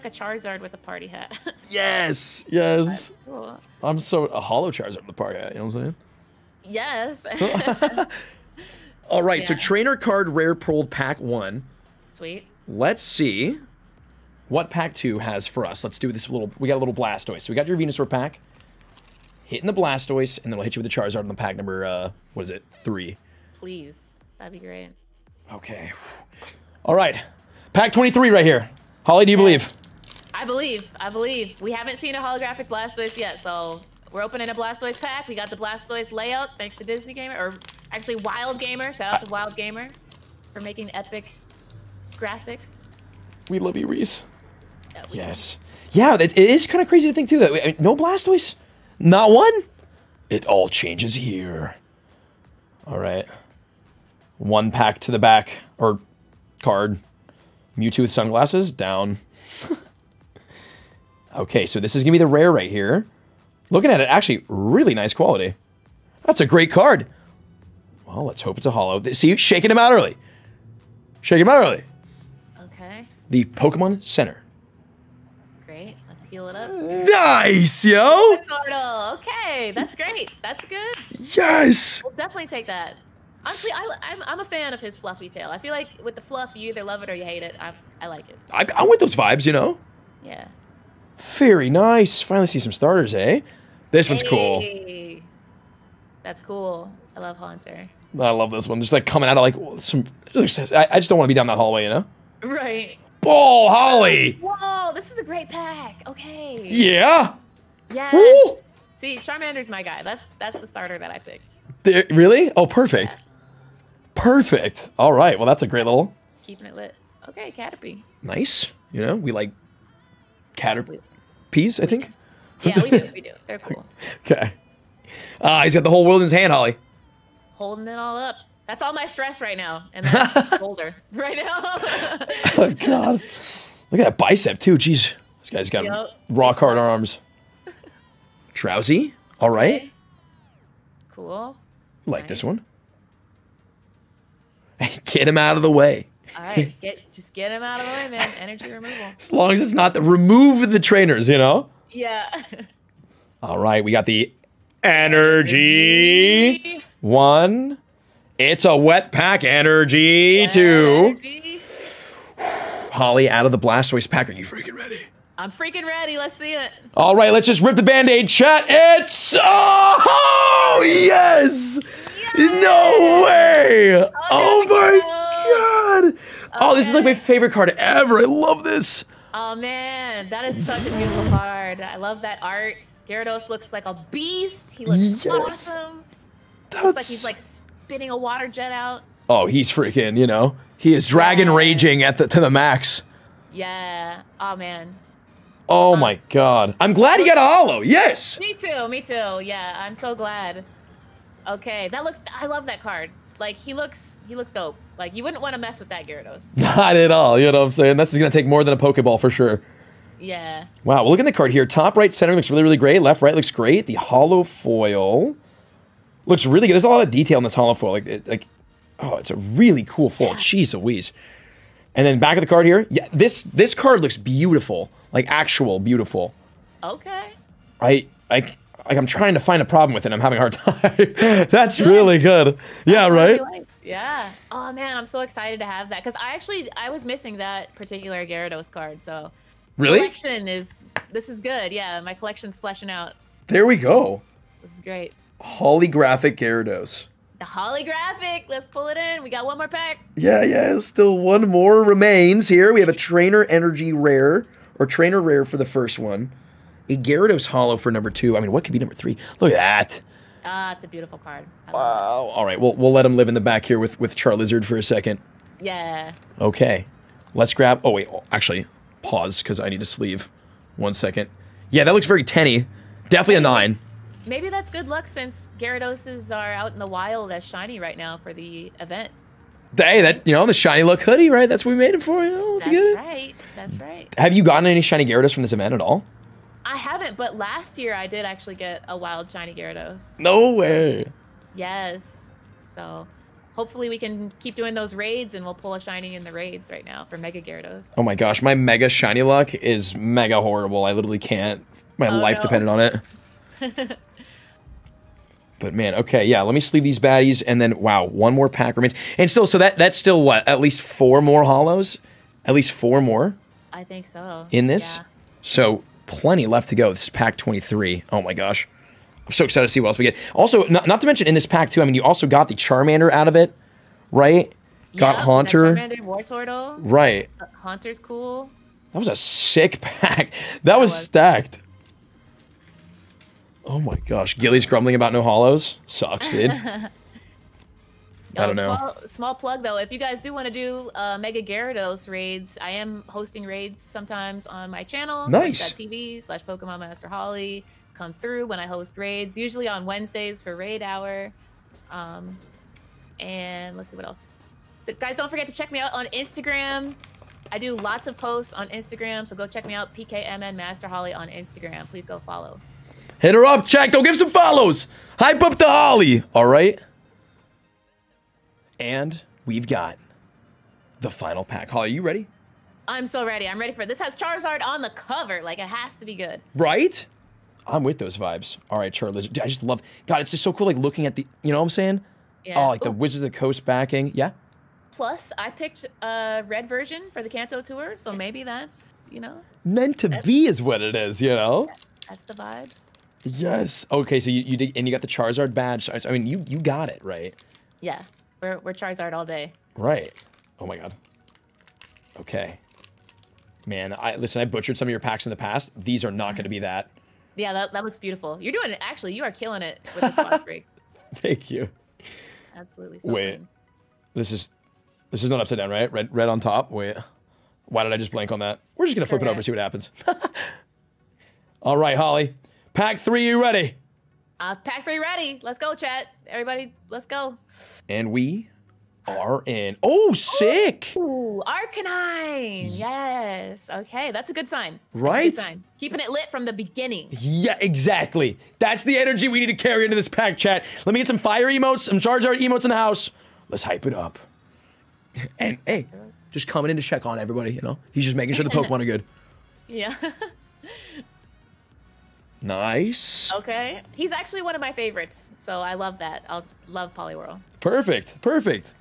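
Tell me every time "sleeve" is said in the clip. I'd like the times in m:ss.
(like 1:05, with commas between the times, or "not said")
4:29, 5:06.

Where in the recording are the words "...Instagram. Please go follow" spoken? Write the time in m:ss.
6:01.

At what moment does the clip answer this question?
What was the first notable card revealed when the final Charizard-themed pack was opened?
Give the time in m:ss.
7:11.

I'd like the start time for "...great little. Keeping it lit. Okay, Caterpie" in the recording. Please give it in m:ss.
1:55.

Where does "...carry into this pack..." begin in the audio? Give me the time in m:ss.
7:19.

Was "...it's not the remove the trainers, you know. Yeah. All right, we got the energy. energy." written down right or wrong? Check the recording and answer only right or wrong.
right.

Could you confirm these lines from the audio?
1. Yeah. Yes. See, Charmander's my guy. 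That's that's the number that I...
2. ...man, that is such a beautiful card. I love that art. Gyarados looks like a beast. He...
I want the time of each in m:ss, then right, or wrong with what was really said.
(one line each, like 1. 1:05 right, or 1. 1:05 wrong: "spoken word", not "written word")
1. 1:46 wrong: "starter", not "number"
2. 2:59 right.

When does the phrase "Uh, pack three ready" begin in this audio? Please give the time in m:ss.
7:04.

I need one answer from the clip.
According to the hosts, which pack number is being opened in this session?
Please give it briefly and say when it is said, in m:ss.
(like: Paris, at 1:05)
23, at 0:27.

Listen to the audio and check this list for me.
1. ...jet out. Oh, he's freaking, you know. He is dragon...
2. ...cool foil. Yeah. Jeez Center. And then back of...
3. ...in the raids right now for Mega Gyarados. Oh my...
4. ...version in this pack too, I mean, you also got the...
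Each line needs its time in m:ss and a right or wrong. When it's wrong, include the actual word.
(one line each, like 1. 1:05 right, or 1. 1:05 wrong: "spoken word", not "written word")
1. 3:08 right
2. 3:39 wrong: "Louise", not "Center"
3. 4:56 right
4. 5:21 wrong: "mention", not "version".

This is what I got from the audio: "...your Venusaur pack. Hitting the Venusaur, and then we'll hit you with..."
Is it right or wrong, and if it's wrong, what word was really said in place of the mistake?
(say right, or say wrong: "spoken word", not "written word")
wrong: "Blastoise", not "Venusaur".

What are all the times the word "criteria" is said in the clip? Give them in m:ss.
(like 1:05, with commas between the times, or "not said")
not said.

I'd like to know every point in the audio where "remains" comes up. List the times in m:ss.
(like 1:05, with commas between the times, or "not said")
4:11, 5:08.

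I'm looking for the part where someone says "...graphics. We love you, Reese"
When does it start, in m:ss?
0:42.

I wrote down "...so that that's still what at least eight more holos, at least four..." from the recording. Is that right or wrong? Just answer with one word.
wrong.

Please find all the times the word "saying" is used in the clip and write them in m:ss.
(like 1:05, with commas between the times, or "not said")
0:05, 3:27, 6:21.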